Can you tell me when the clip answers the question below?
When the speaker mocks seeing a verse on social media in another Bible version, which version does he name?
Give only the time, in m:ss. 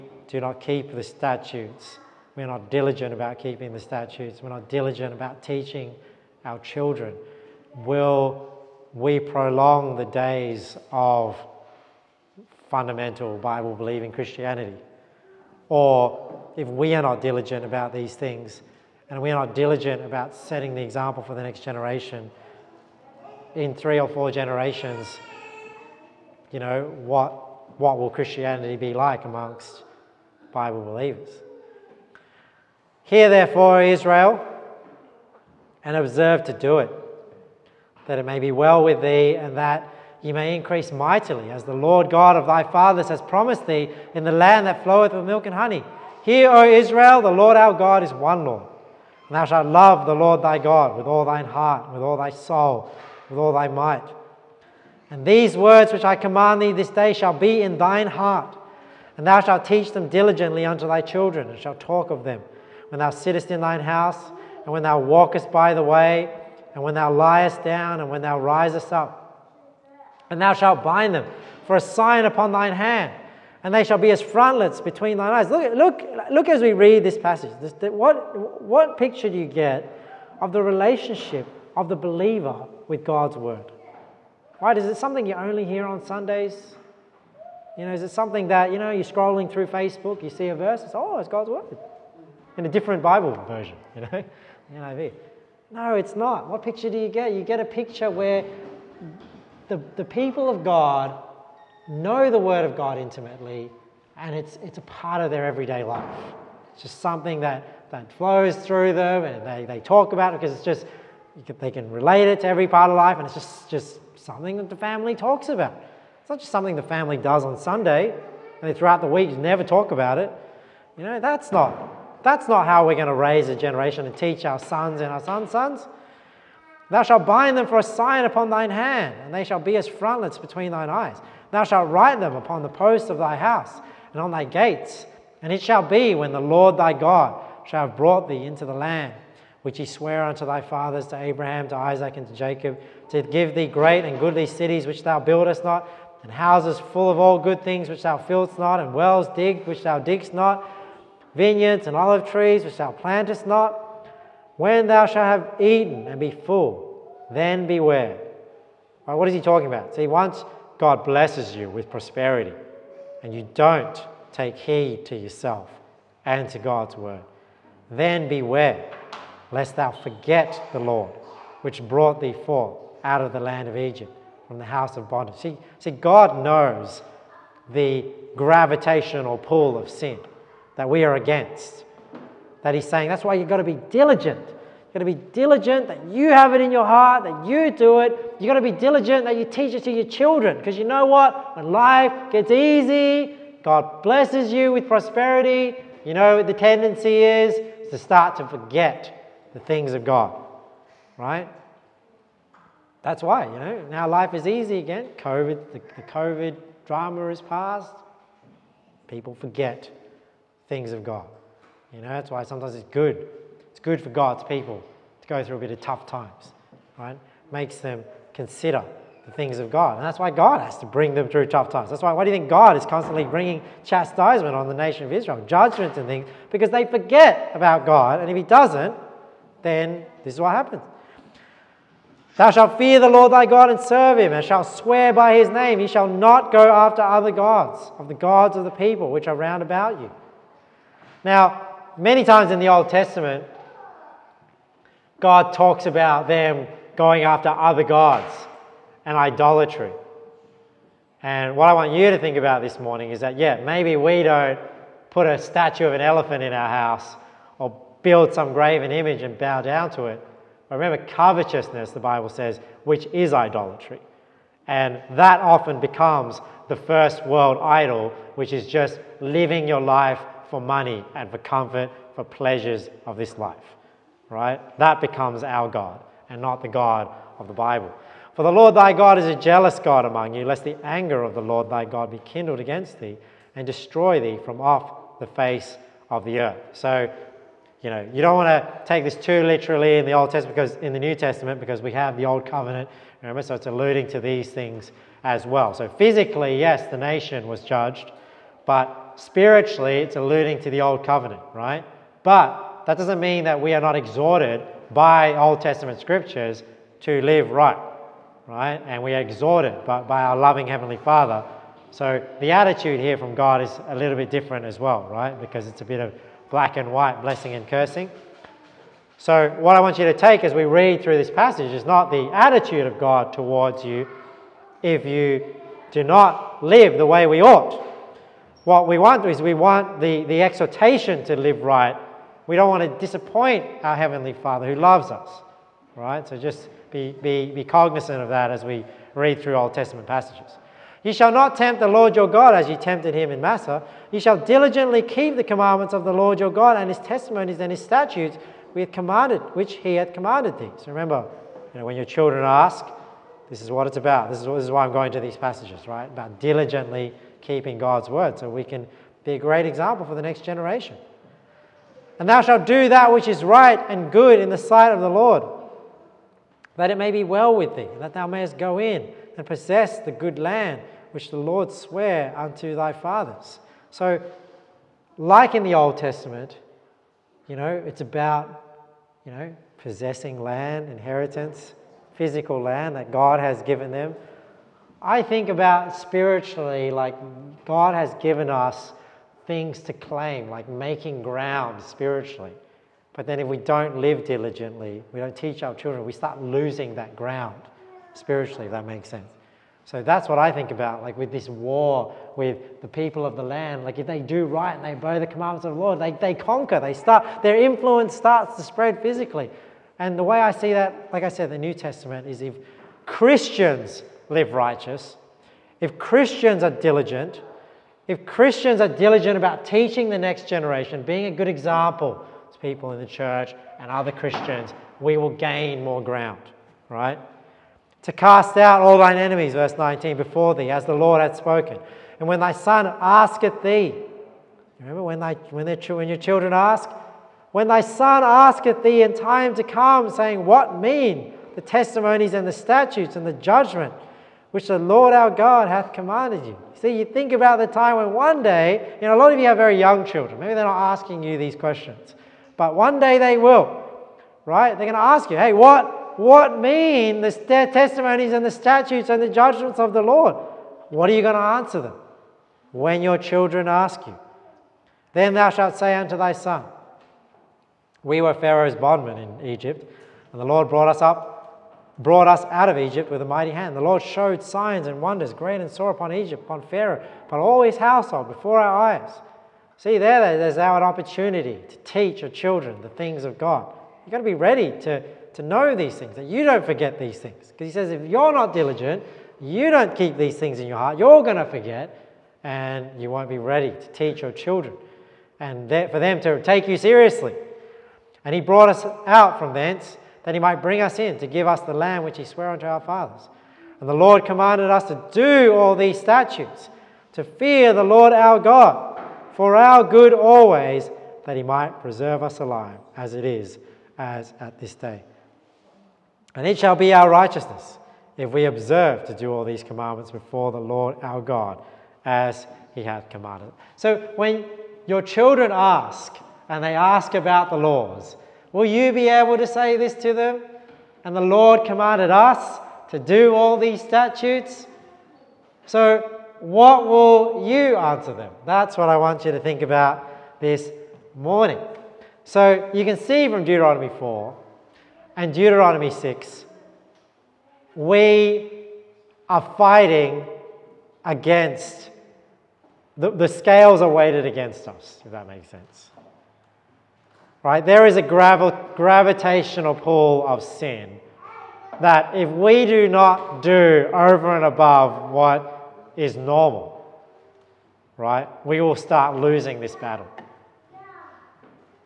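1:34.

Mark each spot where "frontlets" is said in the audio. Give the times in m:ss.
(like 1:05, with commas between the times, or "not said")
1:14, 2:09.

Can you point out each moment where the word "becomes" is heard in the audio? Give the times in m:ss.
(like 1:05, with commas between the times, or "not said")
4:25, 4:35.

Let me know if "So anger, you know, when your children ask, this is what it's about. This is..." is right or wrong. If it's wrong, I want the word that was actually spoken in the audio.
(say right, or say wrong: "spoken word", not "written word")
wrong: "remember", not "anger".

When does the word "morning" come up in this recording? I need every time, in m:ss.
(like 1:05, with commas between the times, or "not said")
4:12, 9:01.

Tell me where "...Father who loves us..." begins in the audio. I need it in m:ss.
5:34.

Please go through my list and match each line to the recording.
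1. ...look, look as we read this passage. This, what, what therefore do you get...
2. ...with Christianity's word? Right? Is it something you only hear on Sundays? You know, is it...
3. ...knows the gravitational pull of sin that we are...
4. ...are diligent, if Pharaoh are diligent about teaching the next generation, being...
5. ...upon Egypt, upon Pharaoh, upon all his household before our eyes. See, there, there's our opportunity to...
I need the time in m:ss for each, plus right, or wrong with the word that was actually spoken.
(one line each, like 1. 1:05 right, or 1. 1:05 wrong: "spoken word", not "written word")
1. 1:15 wrong: "picture", not "therefore"
2. 1:22 wrong: "God", not "Christianity"
3. 2:56 right
4. 6:56 wrong: "Christians", not "Pharaoh"
5. 7:55 right.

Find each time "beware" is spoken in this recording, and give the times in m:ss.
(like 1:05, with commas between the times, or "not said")
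2:37, 2:48.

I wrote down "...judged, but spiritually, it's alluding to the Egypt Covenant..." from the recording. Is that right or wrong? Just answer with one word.
wrong.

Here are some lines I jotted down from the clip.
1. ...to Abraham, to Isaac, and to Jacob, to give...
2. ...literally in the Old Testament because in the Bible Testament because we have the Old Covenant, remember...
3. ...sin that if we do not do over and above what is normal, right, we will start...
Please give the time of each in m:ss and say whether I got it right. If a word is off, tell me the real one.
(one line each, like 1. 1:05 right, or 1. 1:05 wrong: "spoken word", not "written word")
1. 2:21 right
2. 4:49 wrong: "New", not "Bible"
3. 9:20 right.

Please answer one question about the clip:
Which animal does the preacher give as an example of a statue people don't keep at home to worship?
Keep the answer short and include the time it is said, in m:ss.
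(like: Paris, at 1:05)
Elephant, at 4:16.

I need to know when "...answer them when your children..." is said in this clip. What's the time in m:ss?
7:41.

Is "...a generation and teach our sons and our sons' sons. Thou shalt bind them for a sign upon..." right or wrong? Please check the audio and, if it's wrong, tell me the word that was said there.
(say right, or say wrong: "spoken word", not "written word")
right.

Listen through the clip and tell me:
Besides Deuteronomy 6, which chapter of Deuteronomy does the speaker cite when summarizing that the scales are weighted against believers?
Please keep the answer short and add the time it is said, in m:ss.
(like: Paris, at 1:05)
Deuteronomy 4, at 9:03.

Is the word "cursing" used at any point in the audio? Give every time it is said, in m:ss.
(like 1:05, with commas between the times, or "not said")
5:17.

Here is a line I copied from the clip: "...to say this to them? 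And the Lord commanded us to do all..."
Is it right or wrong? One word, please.
right.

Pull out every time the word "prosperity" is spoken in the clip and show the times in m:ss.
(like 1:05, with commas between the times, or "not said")
2:41, 3:14.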